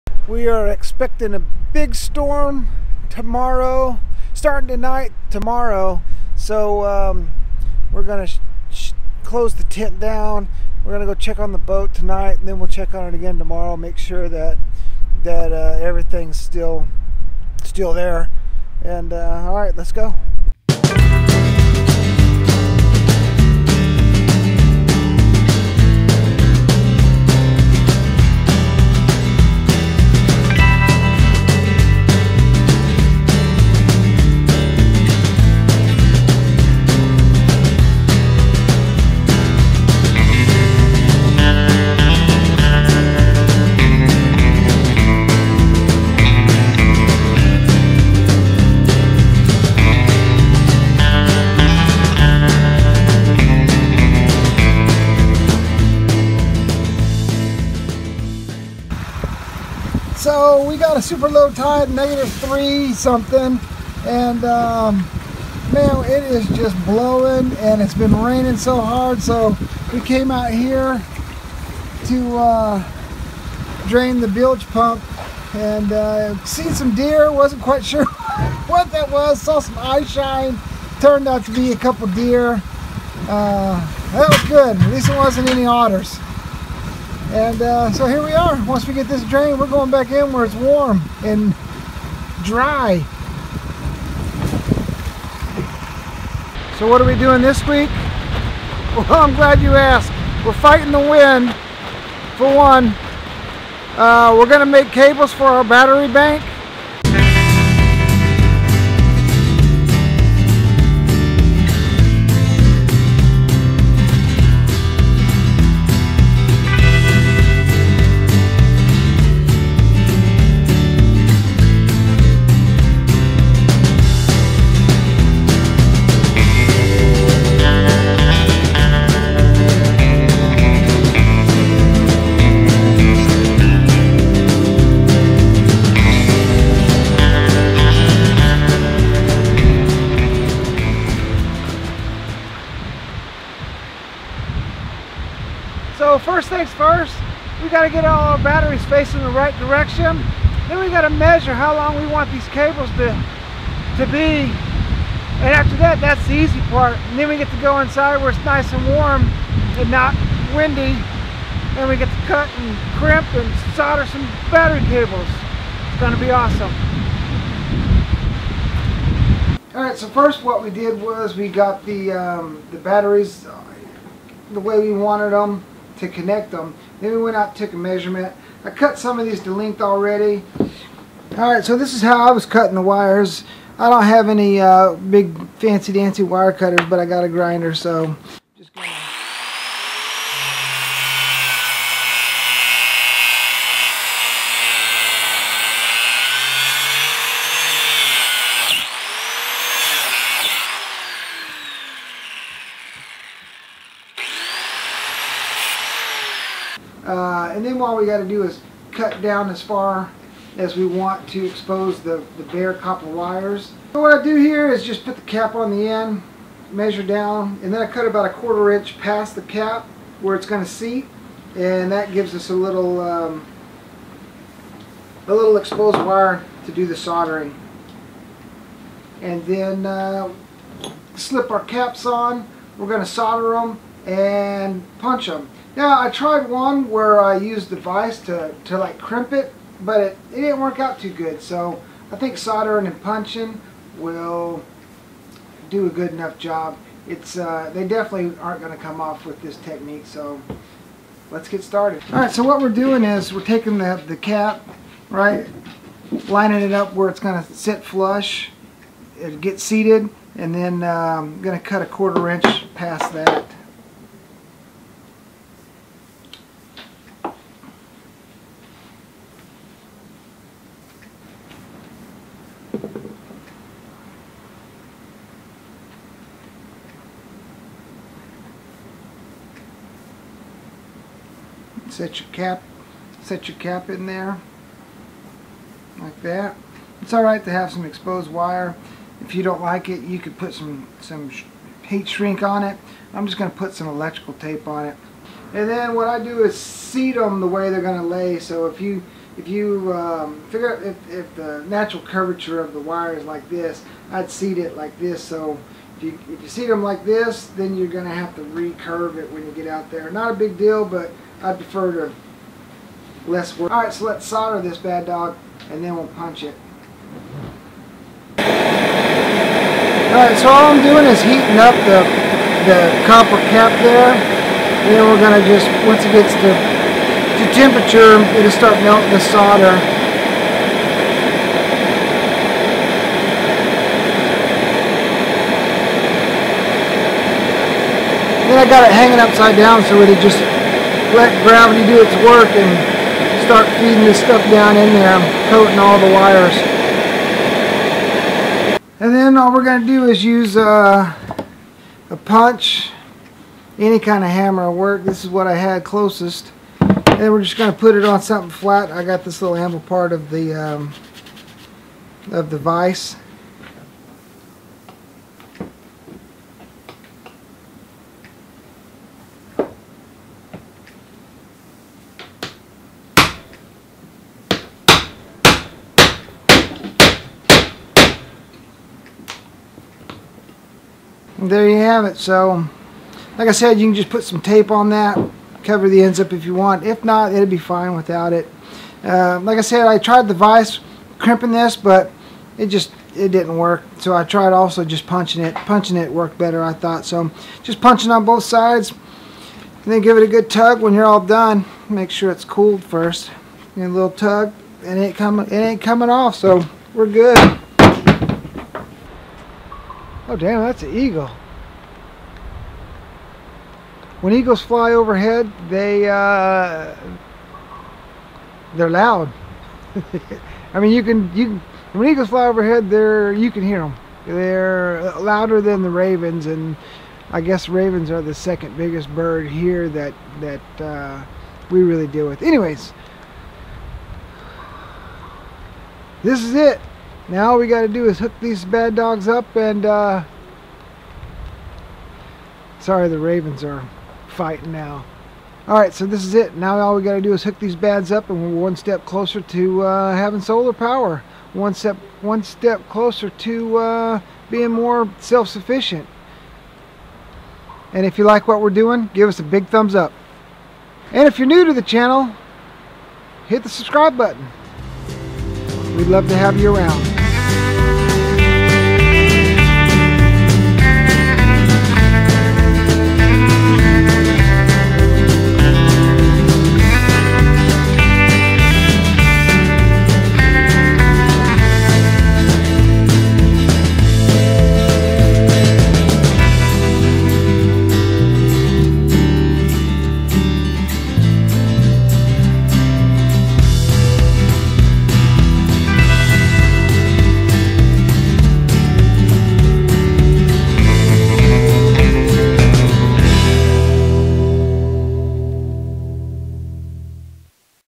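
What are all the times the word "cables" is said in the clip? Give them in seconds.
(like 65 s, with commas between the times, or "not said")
104 s, 152 s, 164 s.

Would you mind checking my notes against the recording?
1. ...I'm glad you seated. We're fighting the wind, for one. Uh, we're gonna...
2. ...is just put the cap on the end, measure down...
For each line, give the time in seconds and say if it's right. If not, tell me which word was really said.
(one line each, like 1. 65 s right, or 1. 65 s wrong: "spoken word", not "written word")
1. 99 s wrong: "asked", not "seated"
2. 214 s right.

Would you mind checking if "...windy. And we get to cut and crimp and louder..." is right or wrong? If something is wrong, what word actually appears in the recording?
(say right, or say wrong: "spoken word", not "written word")
wrong: "solder", not "louder".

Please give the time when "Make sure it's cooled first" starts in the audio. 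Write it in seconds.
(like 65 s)
401 s.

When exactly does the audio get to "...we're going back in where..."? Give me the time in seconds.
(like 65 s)
89 s.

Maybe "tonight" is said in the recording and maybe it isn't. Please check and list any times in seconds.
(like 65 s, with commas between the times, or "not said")
4 s, 11 s.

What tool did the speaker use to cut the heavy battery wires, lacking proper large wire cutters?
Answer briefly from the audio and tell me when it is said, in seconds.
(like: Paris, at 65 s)
a grinder, at 186 s.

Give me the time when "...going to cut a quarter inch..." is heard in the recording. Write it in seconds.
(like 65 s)
261 s.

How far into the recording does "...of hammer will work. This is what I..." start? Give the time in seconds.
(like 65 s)
354 s.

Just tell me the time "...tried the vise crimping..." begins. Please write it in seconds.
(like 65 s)
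389 s.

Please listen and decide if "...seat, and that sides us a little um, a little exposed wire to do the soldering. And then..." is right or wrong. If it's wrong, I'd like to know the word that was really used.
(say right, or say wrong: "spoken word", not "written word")
wrong: "gives", not "sides".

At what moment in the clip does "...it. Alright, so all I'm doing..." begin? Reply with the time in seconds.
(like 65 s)
316 s.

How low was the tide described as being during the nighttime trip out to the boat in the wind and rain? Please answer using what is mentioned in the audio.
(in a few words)
negative 3 something.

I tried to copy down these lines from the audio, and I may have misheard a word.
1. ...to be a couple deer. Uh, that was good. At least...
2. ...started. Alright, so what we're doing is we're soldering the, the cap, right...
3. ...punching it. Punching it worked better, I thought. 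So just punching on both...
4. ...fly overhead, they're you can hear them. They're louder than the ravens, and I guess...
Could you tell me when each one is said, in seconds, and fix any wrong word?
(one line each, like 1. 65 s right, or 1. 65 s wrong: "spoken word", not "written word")
1. 81 s right
2. 251 s wrong: "taking", not "soldering"
3. 395 s right
4. 422 s right.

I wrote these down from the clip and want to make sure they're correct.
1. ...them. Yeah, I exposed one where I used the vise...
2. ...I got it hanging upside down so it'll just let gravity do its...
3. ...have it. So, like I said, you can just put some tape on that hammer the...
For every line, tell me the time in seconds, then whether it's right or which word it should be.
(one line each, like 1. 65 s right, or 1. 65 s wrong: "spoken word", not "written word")
1. 235 s wrong: "tried", not "exposed"
2. 338 s right
3. 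381 s wrong: "cover", not "hammer".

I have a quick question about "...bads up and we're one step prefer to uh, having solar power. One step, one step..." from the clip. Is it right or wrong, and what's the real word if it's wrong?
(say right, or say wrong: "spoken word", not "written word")
wrong: "closer", not "prefer".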